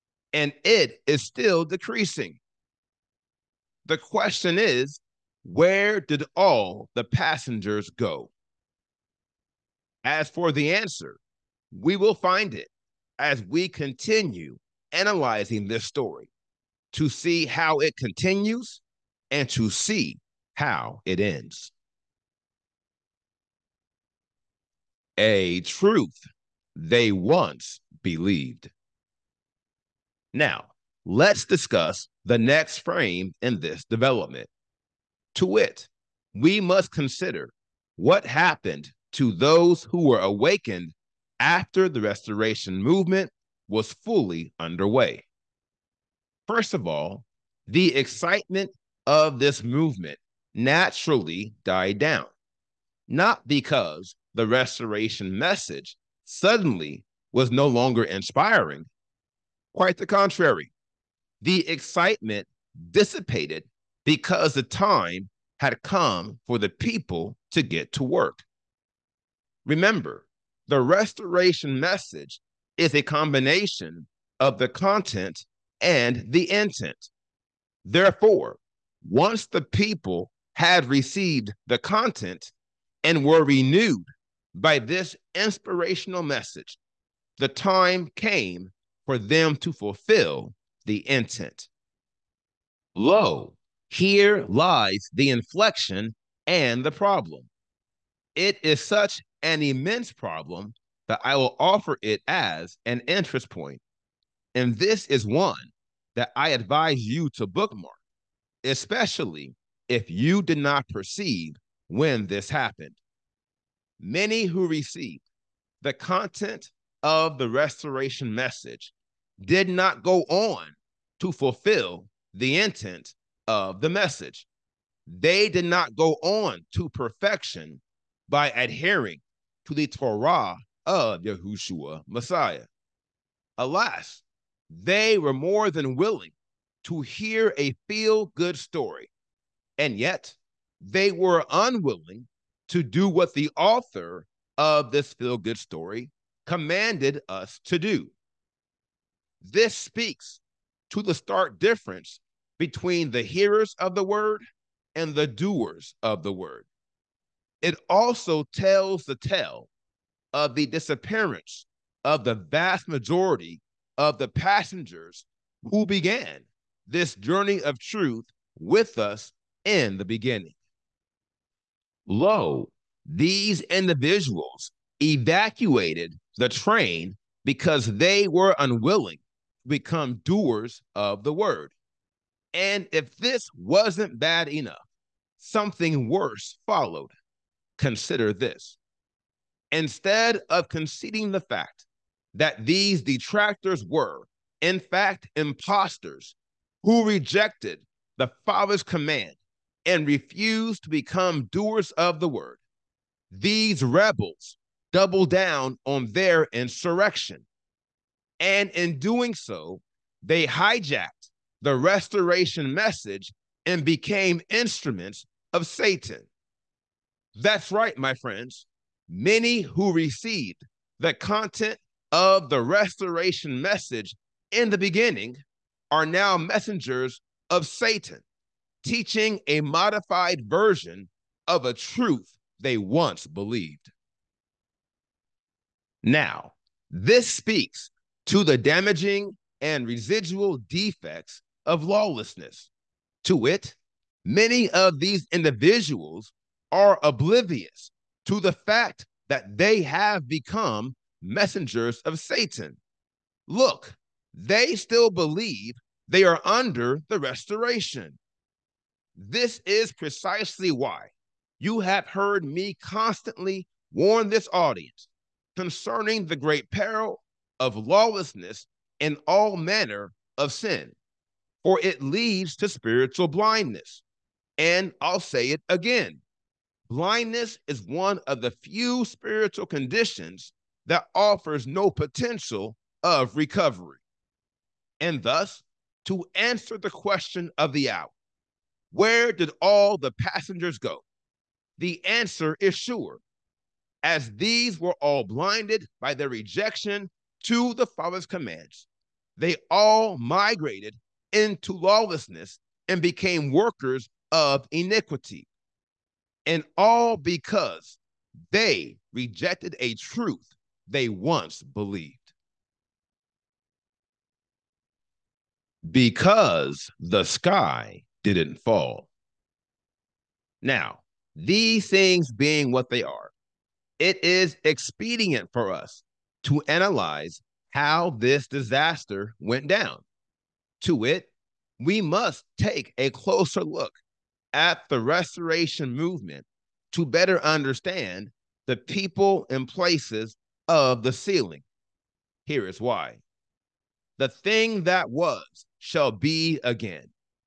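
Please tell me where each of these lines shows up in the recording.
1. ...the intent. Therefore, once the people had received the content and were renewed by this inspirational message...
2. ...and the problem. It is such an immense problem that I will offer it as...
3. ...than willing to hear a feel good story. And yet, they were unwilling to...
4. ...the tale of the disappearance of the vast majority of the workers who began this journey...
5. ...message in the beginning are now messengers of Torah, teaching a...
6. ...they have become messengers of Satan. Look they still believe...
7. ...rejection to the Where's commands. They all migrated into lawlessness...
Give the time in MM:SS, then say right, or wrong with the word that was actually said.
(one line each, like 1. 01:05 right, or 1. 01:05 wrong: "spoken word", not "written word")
1. 01:16 right
2. 01:36 right
3. 02:15 right
4. 02:39 wrong: "passengers", not "workers"
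5. 03:43 wrong: "Satan", not "Torah"
6. 04:09 right
7. 04:56 wrong: "Father", not "Where".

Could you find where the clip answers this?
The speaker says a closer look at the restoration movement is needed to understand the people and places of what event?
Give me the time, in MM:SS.
05:41.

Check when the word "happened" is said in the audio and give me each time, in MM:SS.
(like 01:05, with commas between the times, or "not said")
00:38, 01:52.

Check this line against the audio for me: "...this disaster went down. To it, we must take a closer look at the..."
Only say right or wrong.
right.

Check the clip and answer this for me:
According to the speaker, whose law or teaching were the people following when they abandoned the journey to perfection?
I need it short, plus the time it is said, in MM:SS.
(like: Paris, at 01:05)
Yahushua Messiah, at 02:11.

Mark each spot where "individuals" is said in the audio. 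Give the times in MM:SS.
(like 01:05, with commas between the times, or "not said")
02:53, 04:05.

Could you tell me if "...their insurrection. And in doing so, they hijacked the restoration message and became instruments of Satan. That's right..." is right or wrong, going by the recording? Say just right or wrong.
right.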